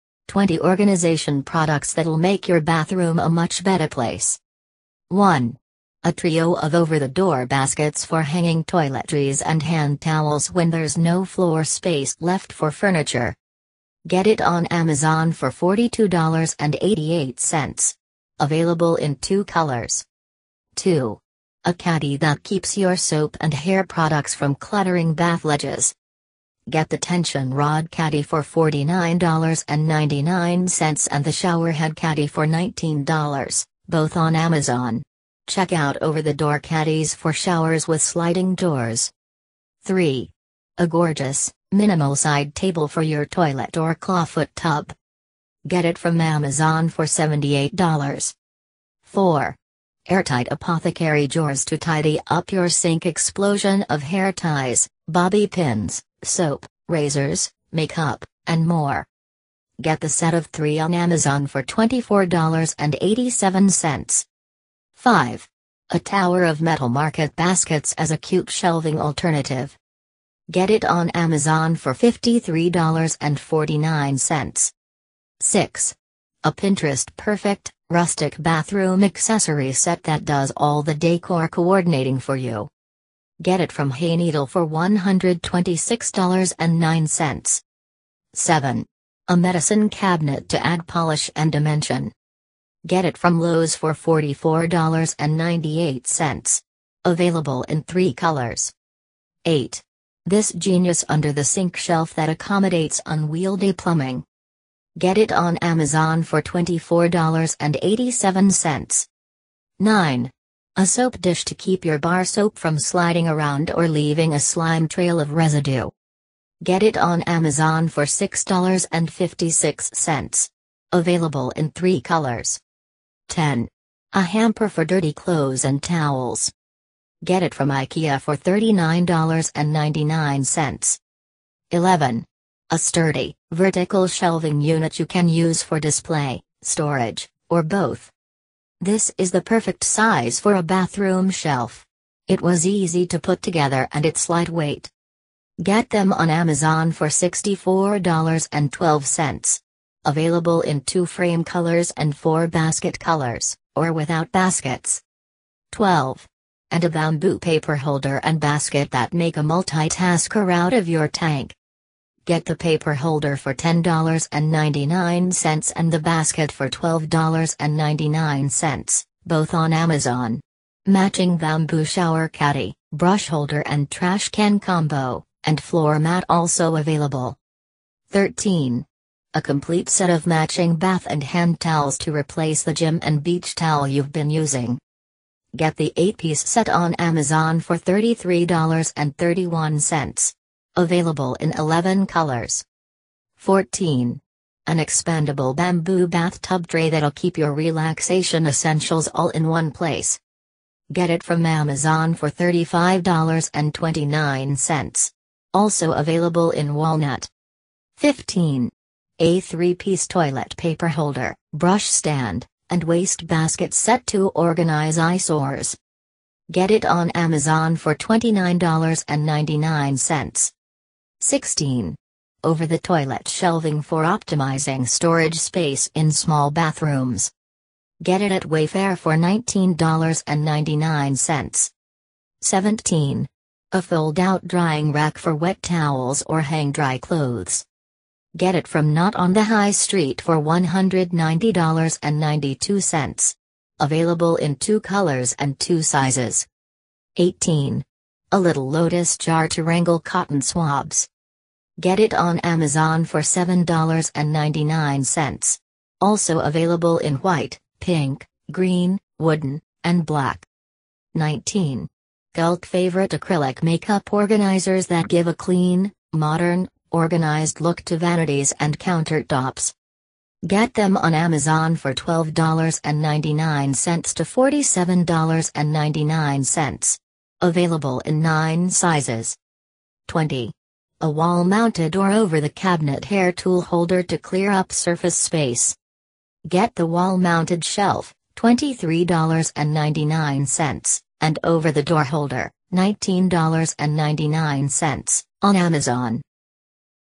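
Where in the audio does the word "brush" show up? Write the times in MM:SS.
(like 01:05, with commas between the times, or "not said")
02:52, 03:31.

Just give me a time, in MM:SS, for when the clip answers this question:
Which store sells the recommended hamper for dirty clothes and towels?
02:07.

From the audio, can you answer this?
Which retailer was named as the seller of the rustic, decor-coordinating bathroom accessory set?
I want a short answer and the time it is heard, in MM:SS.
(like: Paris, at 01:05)
Hayneedle, at 01:23.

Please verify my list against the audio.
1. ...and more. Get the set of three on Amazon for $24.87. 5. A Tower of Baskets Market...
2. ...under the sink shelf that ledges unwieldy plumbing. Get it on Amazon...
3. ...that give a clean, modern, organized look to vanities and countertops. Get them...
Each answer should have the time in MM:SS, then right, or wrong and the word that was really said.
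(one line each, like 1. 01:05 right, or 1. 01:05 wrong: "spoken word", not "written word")
1. 00:58 wrong: "Metal", not "Baskets"
2. 01:41 wrong: "accommodates", not "ledges"
3. 04:24 right.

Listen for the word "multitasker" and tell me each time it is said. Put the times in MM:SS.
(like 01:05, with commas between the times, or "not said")
02:39.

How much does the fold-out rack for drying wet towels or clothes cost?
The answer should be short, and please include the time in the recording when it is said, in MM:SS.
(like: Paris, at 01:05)
$190.92, at 04:00.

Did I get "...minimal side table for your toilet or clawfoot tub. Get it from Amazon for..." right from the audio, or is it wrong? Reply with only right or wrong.
right.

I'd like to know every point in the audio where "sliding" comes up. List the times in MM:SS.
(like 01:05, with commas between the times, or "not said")
00:38, 01:52.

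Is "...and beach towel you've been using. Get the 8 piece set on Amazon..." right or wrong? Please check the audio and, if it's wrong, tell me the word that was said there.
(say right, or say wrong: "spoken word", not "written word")
right.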